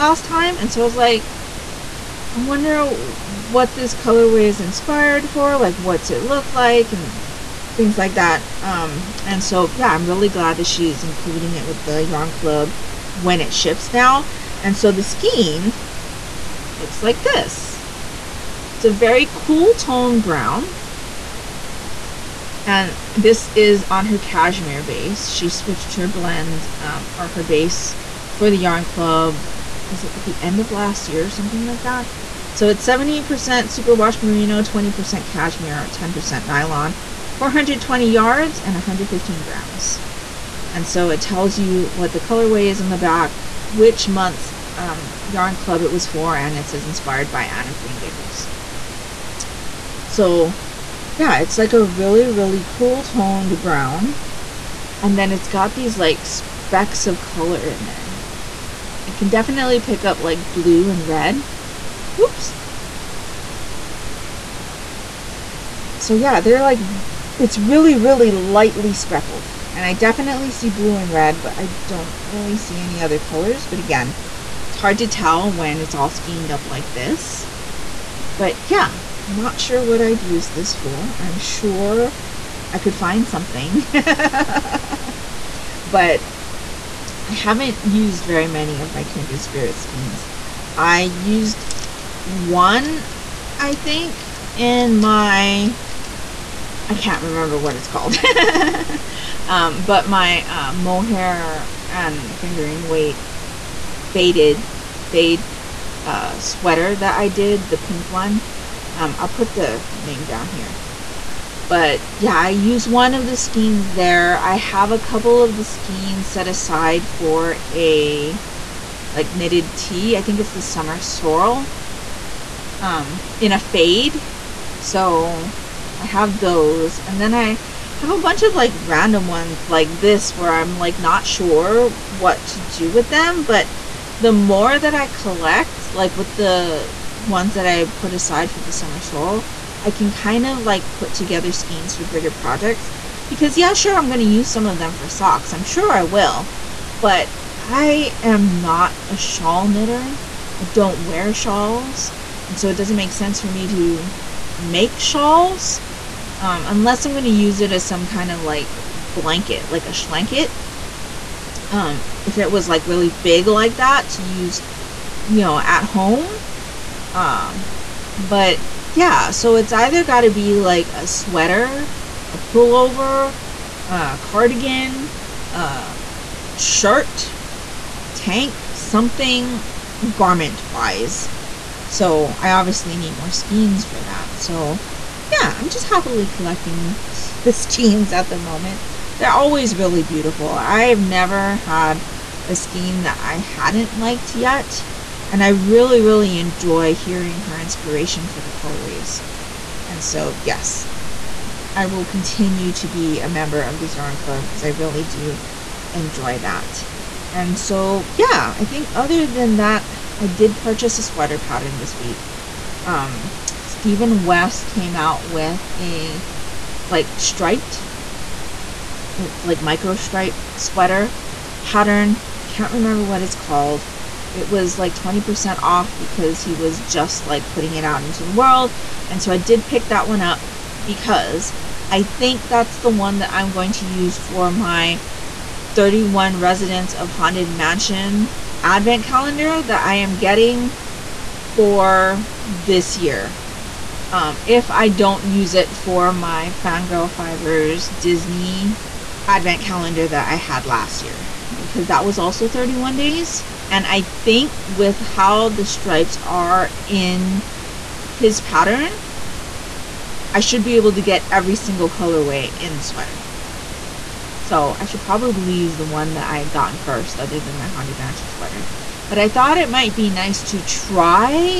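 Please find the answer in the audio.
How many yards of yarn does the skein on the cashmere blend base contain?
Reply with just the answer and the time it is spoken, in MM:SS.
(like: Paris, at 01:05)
420, at 00:37.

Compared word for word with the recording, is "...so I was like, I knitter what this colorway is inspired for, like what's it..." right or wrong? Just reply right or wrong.
wrong.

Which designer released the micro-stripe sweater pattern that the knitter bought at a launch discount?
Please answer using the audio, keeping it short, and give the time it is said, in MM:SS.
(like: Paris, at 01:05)
Stephen West, at 03:33.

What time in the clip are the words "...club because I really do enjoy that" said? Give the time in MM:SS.
03:24.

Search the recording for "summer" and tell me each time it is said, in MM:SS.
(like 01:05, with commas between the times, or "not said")
02:00, 02:18.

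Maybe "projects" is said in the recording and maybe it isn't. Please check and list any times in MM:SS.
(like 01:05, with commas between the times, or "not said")
02:22.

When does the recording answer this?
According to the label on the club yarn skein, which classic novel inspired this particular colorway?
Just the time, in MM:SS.
00:47.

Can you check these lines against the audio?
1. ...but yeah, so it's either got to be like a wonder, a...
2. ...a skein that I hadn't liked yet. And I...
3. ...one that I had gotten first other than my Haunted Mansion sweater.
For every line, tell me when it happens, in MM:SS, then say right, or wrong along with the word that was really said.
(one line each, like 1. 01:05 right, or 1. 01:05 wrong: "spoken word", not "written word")
1. 02:48 wrong: "sweater", not "wonder"
2. 03:12 right
3. 04:25 right.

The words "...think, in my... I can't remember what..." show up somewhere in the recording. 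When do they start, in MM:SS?
01:33.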